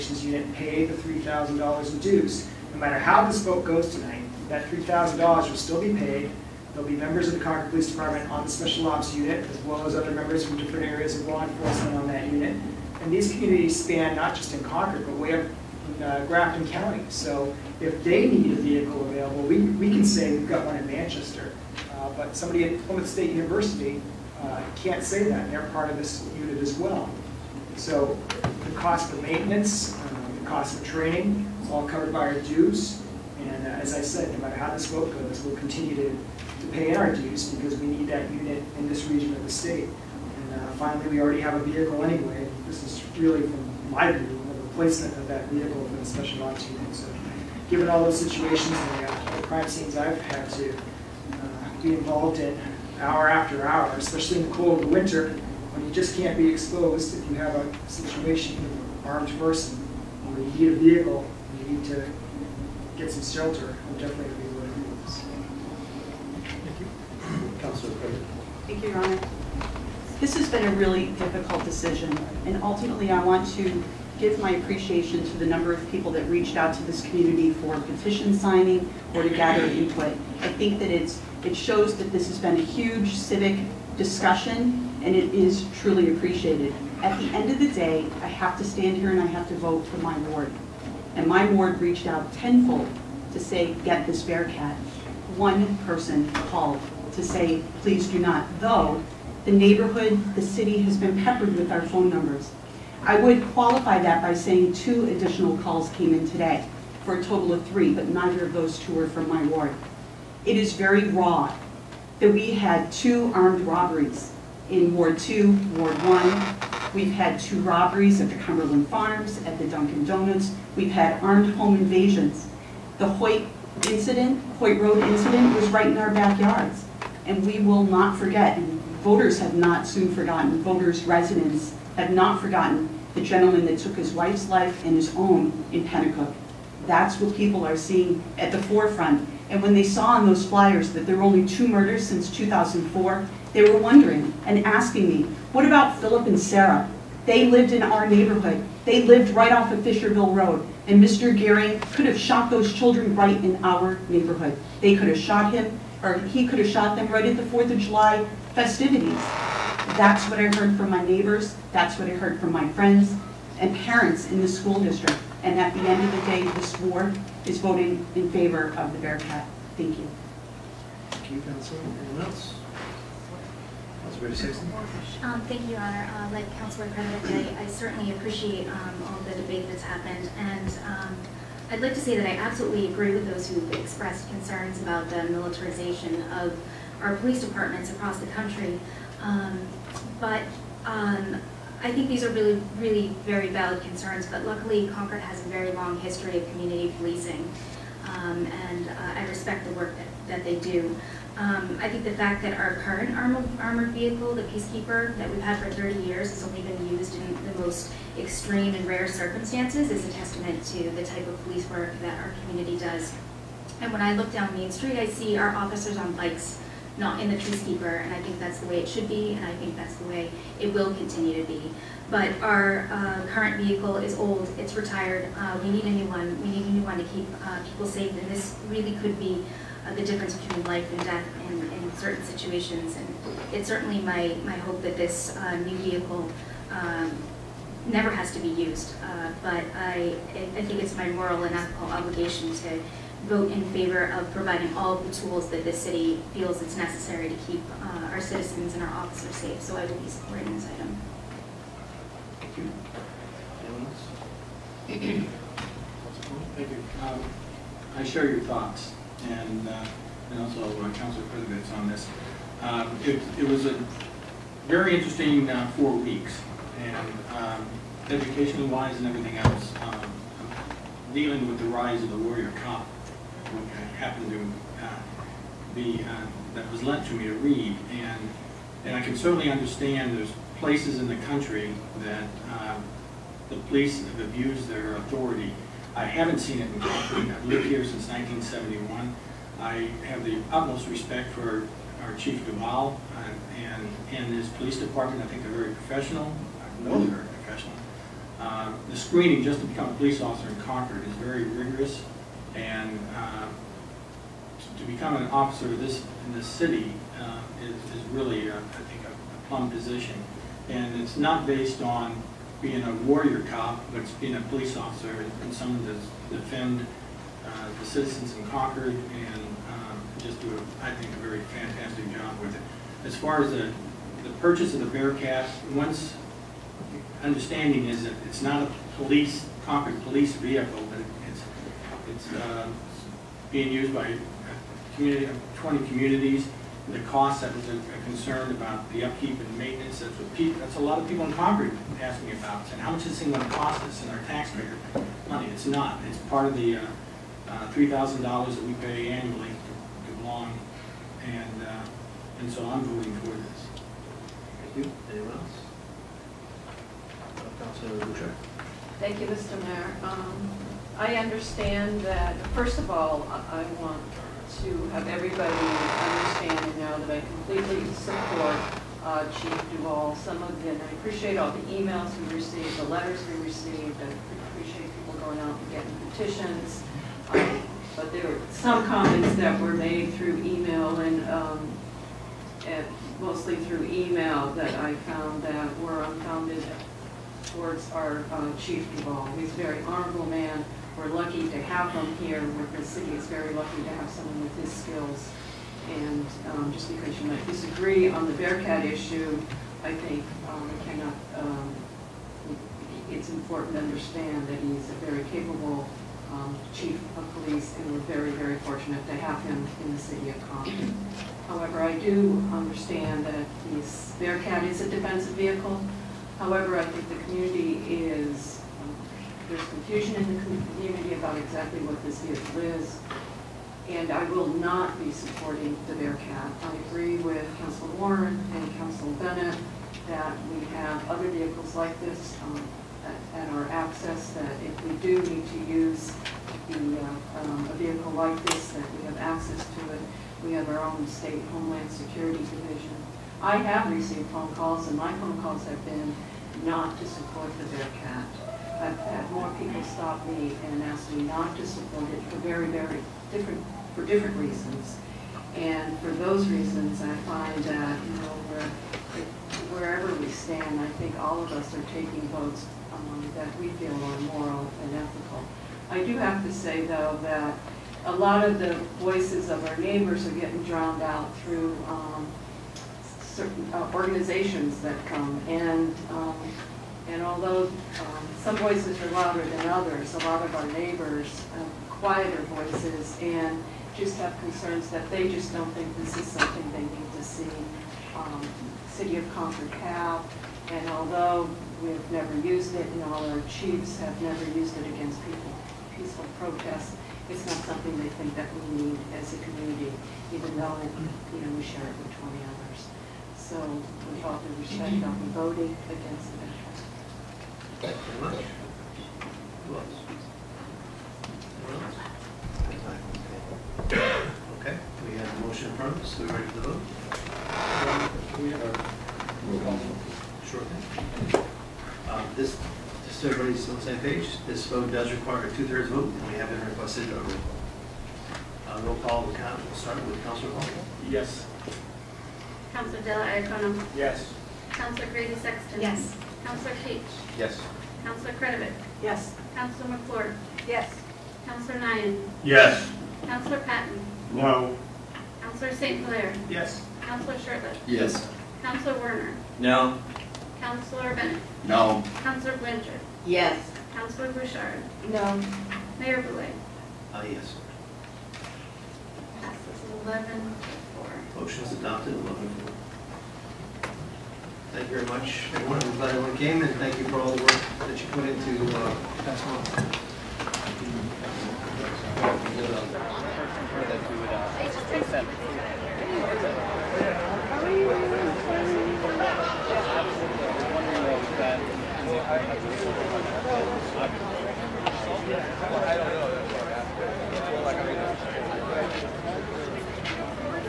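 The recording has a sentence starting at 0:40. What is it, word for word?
And uh, finally, we already have a vehicle anyway.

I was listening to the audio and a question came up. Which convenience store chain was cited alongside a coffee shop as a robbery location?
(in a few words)
Cumberland Farms.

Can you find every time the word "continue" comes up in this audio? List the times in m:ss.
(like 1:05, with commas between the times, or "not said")
0:35, 3:40.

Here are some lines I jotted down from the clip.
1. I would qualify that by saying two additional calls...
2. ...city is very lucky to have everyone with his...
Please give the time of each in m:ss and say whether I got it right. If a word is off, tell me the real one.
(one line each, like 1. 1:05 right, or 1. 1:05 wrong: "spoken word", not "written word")
1. 1:43 right
2. 6:32 wrong: "someone", not "everyone".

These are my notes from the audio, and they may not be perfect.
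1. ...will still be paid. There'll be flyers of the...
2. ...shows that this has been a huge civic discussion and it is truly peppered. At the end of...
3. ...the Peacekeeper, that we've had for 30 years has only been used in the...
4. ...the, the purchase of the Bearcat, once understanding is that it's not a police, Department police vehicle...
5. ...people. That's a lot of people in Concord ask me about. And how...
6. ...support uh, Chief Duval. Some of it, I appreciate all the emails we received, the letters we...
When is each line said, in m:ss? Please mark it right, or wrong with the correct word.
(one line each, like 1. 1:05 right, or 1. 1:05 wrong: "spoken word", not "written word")
1. 0:05 wrong: "members", not "flyers"
2. 1:21 wrong: "appreciated", not "peppered"
3. 3:24 right
4. 5:23 wrong: "Concord", not "Department"
5. 5:40 right
6. 6:07 right.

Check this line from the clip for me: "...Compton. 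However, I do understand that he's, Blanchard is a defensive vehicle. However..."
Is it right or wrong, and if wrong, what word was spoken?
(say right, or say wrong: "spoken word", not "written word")
wrong: "Bearcat", not "Blanchard".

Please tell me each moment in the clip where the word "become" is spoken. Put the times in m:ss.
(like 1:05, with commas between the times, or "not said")
4:59, 5:04.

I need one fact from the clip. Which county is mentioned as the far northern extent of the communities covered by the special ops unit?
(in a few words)
Grafton County.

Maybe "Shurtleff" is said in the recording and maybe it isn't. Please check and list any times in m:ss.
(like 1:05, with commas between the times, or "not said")
9:07.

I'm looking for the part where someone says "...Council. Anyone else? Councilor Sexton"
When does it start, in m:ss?
2:51.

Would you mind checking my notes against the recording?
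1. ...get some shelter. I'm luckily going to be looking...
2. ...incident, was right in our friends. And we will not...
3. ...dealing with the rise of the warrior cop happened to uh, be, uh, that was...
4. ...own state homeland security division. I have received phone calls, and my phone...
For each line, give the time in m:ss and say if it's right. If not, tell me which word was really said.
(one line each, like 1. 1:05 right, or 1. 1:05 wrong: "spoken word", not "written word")
1. 1:02 wrong: "definitely", not "luckily"
2. 2:05 wrong: "backyards", not "friends"
3. 4:31 right
4. 7:20 right.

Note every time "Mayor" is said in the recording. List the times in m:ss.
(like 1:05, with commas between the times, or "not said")
5:59, 9:15.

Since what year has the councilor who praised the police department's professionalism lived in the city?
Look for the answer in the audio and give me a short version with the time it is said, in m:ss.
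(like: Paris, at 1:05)
1971, at 4:48.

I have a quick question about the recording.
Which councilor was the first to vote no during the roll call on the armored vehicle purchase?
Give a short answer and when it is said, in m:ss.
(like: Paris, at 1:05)
Patten, at 9:03.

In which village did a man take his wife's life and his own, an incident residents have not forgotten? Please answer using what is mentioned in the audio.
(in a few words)
Penacook.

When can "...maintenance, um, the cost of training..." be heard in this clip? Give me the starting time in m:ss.
0:29.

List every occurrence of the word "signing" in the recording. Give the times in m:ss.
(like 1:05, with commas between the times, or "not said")
1:18.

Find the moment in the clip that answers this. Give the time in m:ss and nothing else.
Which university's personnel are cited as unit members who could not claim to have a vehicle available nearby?
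0:22.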